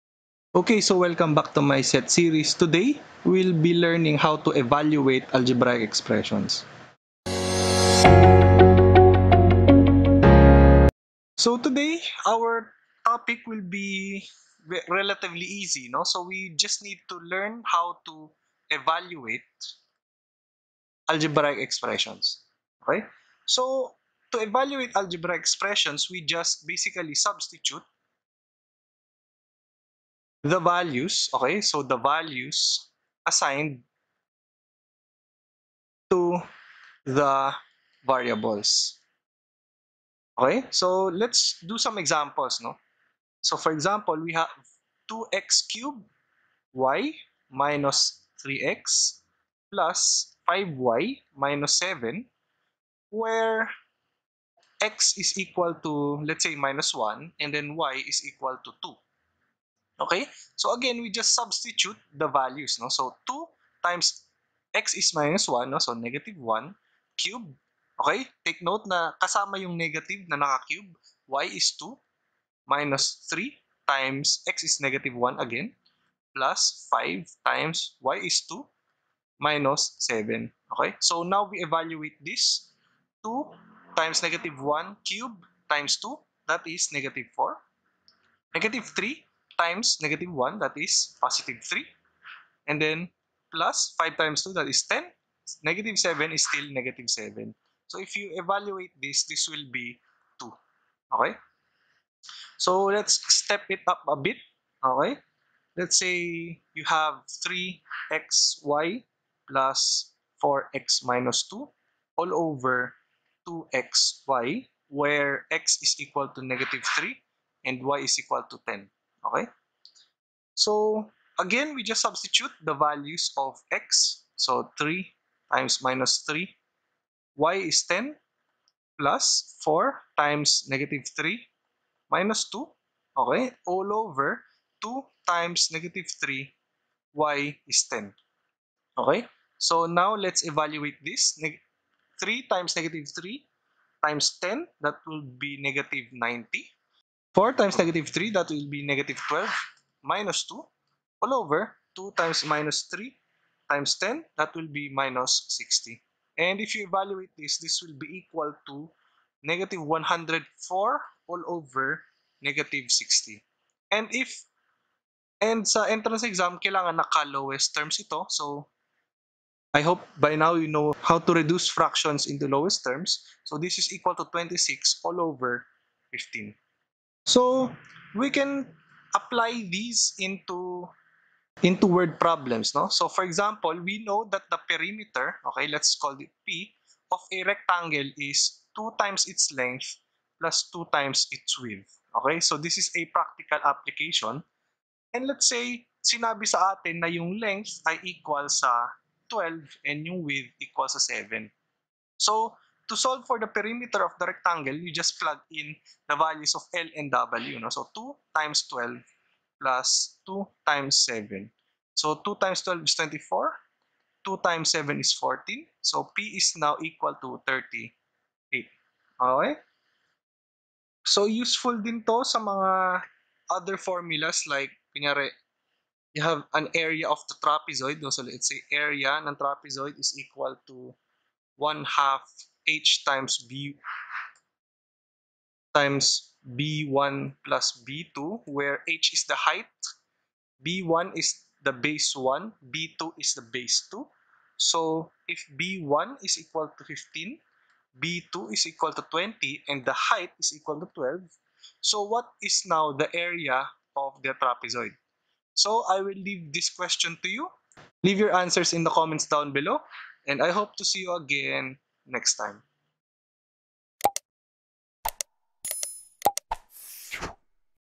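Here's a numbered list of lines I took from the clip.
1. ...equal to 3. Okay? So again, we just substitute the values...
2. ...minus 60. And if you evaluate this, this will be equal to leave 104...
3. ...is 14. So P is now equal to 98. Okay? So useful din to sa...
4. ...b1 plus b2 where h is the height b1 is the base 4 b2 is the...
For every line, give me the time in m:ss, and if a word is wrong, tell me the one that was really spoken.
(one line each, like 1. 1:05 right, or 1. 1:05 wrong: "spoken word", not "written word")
1. 0:58 wrong: "2", not "3"
2. 2:34 wrong: "negative", not "leave"
3. 3:34 wrong: "38", not "98"
4. 3:56 wrong: "1", not "4".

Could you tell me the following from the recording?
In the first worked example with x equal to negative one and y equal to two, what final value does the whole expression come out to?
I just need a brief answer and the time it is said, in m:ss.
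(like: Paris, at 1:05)
2, at 1:39.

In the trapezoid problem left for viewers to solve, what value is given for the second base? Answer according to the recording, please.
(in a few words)
20.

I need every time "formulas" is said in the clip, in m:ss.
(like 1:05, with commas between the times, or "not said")
3:43.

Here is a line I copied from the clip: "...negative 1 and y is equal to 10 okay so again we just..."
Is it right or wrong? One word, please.
wrong.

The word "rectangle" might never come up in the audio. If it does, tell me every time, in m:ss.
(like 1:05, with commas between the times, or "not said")
3:07, 3:24.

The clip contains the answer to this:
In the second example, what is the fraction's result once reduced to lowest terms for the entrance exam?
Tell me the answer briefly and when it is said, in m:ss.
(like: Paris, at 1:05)
26/15, at 2:54.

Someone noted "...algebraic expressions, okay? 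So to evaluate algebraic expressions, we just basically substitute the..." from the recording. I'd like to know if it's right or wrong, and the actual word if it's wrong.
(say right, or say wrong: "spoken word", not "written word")
right.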